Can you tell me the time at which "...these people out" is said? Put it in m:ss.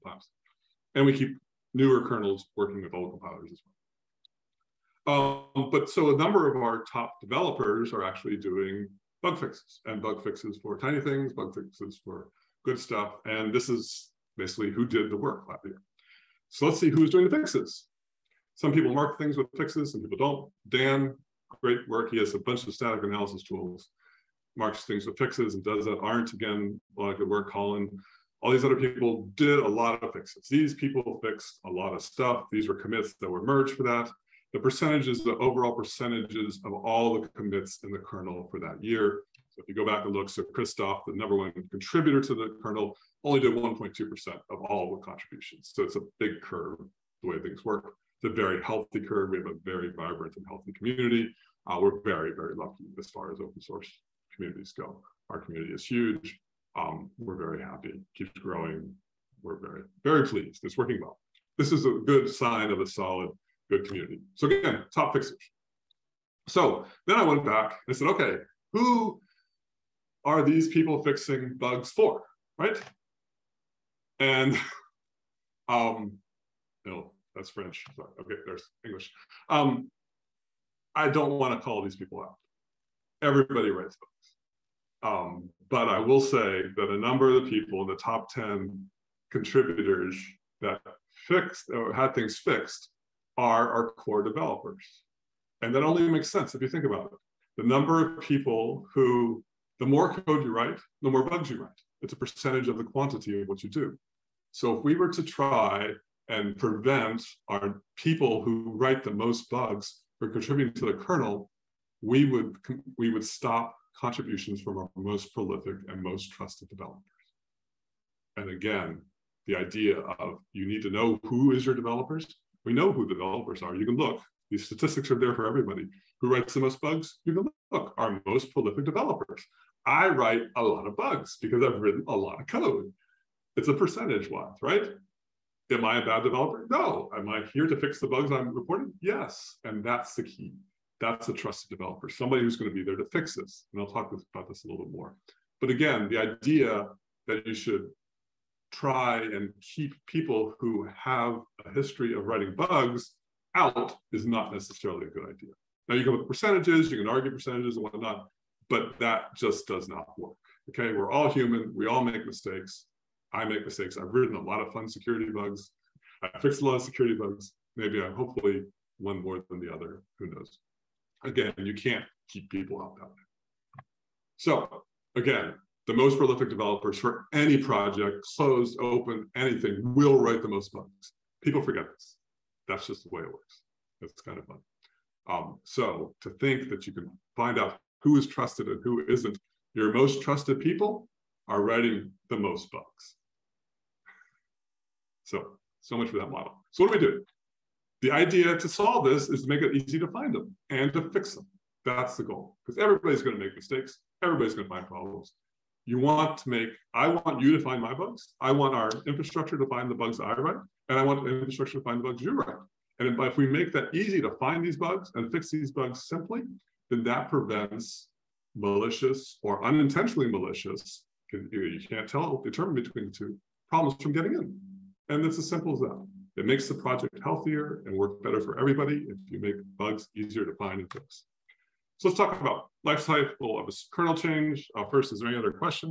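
1:21.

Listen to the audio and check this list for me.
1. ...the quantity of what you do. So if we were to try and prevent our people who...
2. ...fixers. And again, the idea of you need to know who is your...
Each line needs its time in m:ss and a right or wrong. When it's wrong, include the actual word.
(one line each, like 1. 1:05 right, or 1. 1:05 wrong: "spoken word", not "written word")
1. 1:42 right
2. 1:56 wrong: "developers", not "fixers".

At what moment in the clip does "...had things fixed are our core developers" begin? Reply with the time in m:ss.
1:31.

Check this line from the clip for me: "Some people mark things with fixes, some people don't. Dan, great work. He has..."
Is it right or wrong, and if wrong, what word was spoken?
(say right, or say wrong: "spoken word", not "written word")
right.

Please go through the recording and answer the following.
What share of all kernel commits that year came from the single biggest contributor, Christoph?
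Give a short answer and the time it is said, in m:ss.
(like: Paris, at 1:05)
1.2%, at 0:43.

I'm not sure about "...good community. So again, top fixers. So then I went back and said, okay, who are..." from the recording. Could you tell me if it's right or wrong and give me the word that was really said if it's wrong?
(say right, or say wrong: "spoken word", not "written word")
right.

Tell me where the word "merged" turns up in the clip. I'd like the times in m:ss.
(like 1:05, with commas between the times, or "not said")
0:33.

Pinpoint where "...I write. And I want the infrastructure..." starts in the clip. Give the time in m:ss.
3:30.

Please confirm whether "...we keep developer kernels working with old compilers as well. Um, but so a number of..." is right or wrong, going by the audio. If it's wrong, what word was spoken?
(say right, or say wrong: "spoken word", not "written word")
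wrong: "newer", not "developer".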